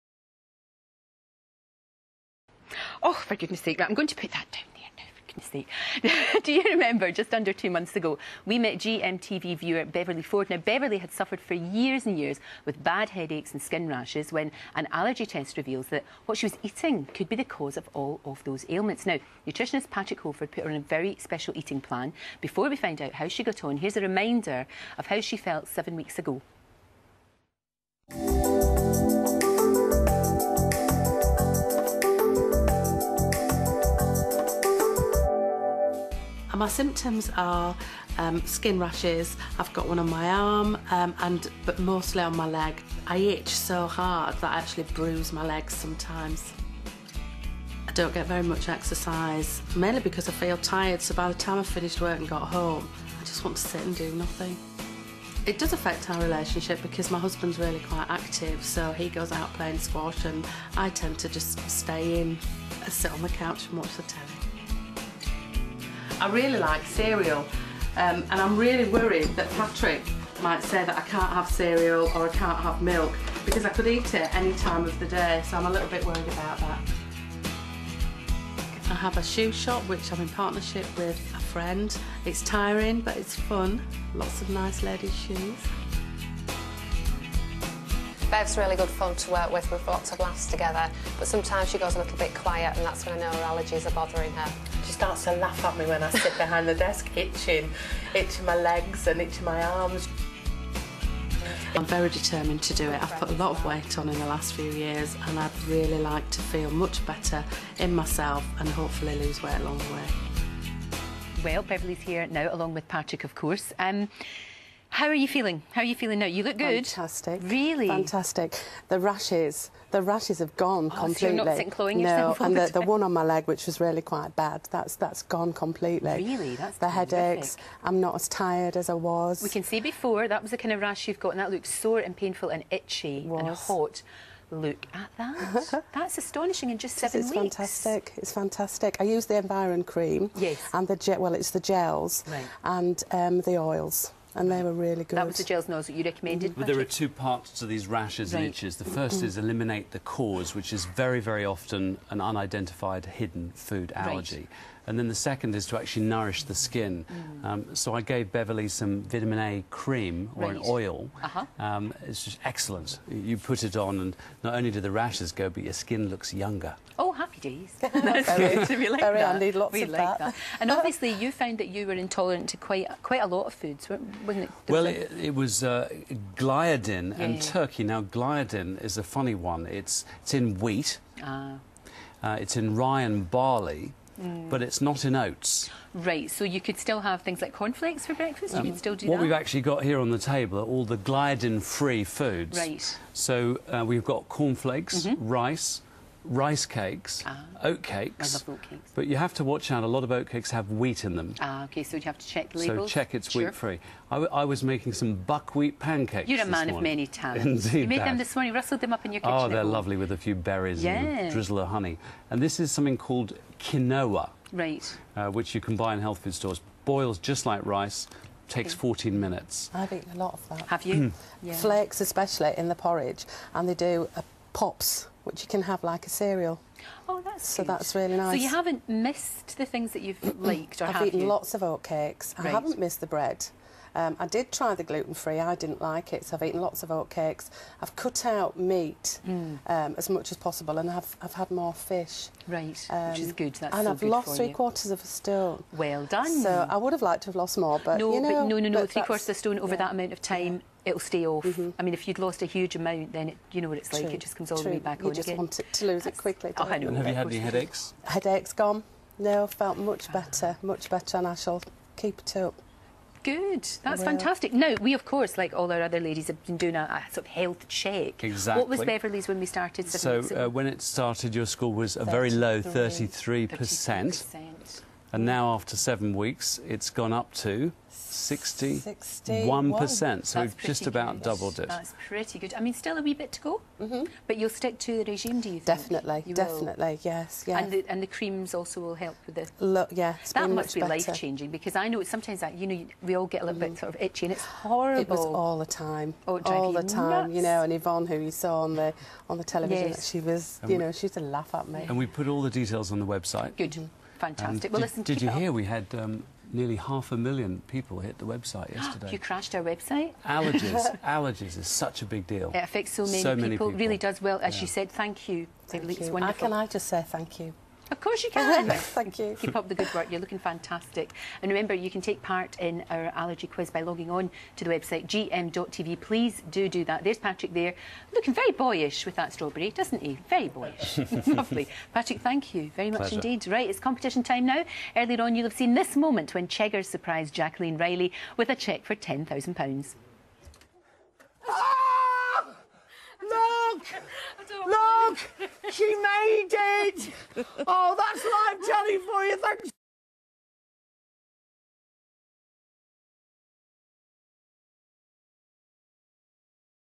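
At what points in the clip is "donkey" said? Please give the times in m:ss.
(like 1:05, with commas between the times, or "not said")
not said.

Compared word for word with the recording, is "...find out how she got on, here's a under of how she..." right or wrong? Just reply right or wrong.
wrong.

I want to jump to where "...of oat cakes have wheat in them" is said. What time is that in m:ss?
3:20.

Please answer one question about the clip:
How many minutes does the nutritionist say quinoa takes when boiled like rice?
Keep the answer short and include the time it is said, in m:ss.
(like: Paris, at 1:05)
14, at 3:38.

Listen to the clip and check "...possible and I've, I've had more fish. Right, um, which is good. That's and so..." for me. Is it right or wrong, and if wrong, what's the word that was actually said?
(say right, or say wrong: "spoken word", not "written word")
right.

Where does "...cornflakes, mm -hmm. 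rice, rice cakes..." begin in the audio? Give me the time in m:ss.
3:14.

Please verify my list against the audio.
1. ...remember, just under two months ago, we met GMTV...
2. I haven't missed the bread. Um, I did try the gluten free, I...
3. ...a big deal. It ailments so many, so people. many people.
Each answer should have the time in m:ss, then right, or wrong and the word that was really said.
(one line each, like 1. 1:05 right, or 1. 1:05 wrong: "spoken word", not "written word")
1. 0:06 right
2. 3:52 right
3. 5:12 wrong: "affects", not "ailments".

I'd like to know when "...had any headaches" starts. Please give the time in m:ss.
4:17.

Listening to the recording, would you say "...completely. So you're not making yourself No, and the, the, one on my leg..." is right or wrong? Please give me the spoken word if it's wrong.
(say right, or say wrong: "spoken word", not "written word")
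wrong: "cloying", not "making".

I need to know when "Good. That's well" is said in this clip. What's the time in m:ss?
4:23.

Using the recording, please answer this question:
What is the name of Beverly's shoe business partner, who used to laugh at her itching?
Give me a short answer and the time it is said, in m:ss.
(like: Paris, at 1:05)
Yvonne, at 4:57.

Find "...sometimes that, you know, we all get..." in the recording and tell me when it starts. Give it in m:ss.
4:52.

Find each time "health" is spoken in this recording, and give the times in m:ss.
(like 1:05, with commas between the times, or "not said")
3:36, 4:27.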